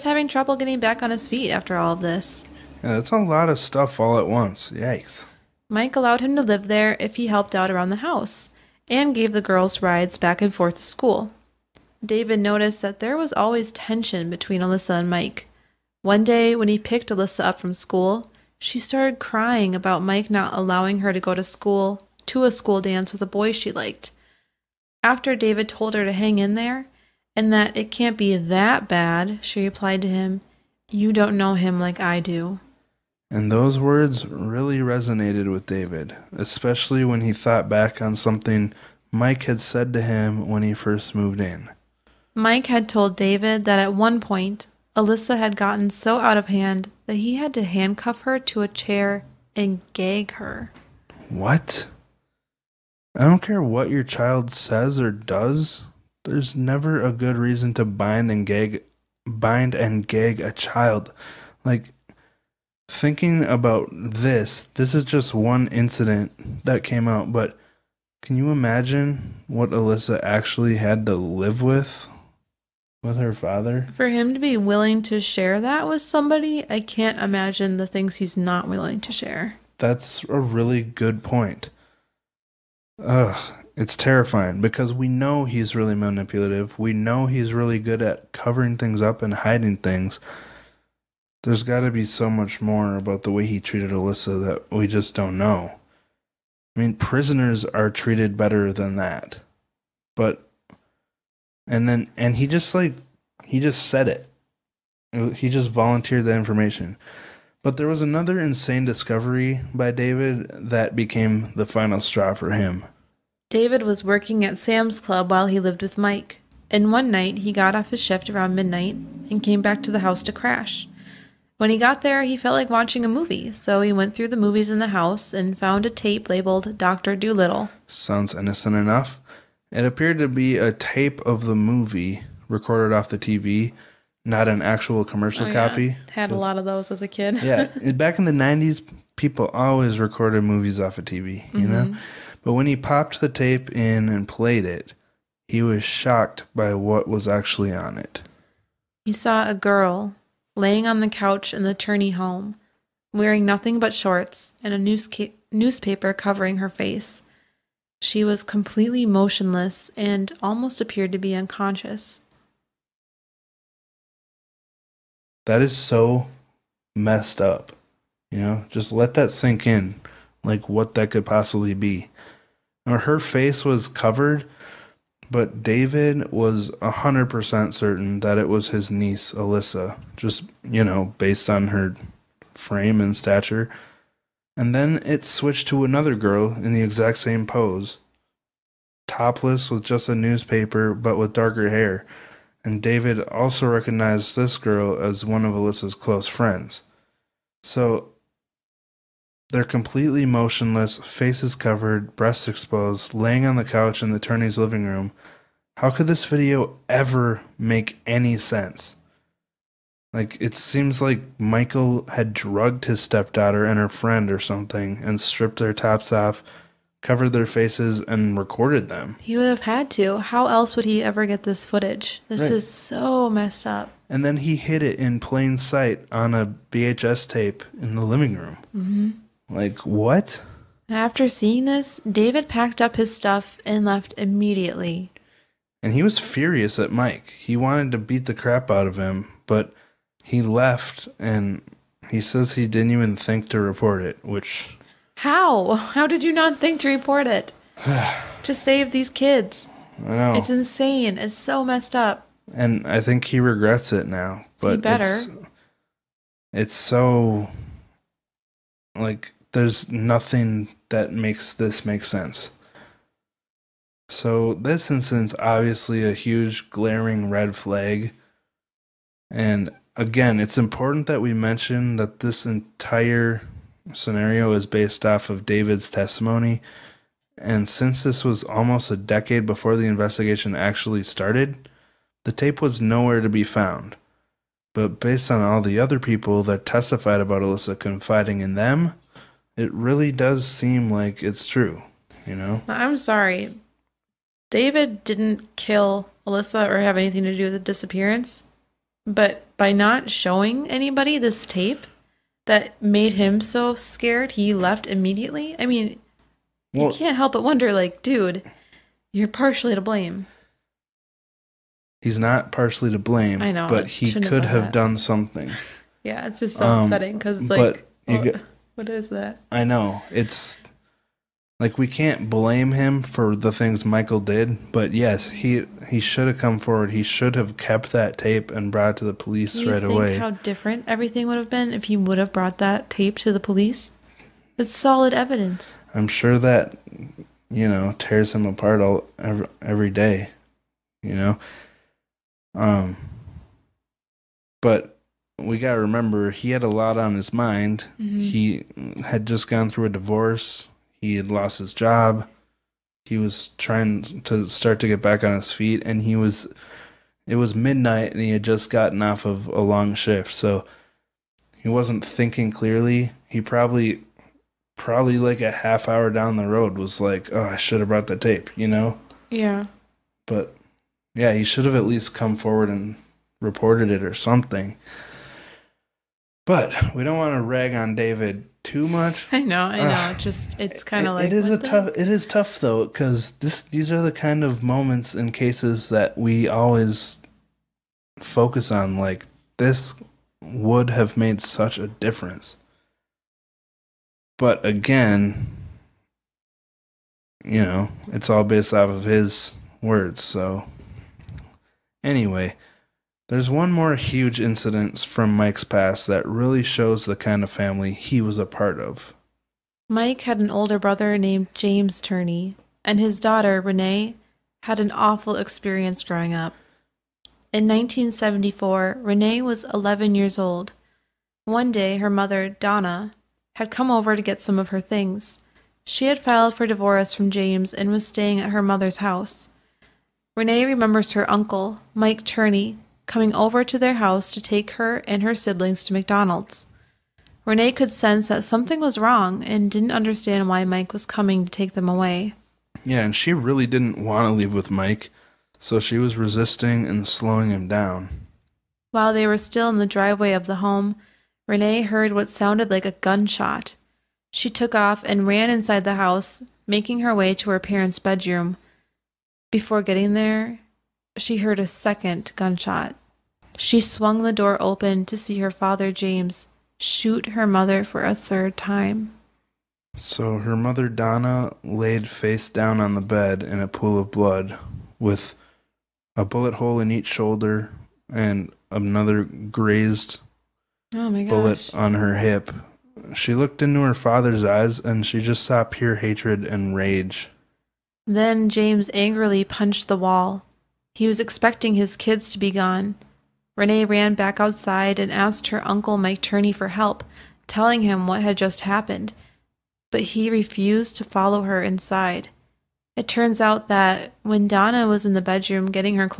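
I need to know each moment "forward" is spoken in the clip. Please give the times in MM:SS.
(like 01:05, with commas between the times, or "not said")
05:26, 06:12.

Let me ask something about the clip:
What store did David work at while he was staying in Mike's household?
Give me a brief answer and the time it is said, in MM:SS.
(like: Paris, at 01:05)
Sam's Club, at 01:54.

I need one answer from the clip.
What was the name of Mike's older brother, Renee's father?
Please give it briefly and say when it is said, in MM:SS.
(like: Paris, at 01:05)
James Turney, at 06:51.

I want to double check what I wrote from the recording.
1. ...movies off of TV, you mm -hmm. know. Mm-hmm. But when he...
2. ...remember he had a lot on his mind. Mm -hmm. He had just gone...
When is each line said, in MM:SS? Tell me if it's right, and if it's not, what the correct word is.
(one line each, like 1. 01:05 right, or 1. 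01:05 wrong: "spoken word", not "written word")
1. 02:20 right
2. 05:45 right.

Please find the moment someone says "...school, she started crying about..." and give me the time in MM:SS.
00:17.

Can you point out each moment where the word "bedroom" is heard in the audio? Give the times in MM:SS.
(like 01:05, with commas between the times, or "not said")
07:37, 08:25.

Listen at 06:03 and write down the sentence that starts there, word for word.
He probably, probably like a half hour down the road, was like, "Oh, I should have brought the tape," you know.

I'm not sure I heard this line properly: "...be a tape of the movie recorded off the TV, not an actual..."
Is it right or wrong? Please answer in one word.
right.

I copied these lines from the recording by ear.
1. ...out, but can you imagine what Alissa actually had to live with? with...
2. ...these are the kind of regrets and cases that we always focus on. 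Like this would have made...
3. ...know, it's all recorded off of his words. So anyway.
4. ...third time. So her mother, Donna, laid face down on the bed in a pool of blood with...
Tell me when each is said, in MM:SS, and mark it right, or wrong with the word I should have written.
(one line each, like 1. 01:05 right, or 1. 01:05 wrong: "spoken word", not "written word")
1. 01:07 right
2. 06:23 wrong: "moments", not "regrets"
3. 06:37 wrong: "based", not "recorded"
4. 07:48 right.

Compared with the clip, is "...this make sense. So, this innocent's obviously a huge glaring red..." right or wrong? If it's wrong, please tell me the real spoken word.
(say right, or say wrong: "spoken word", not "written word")
wrong: "incident", not "innocent".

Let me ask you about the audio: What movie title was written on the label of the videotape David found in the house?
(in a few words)
Dr. Dolittle.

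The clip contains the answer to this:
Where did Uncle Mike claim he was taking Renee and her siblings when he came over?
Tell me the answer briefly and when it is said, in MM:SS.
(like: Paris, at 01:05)
McDonald's, at 07:15.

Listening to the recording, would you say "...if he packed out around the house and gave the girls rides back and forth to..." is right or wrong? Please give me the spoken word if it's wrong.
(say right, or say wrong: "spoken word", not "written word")
wrong: "helped", not "packed".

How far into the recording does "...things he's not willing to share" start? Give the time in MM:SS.
01:17.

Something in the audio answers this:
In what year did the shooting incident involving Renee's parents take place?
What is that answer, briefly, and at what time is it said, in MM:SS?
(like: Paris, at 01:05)
1974, at 06:57.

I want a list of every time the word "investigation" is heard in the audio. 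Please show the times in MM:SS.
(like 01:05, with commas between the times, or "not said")
04:39.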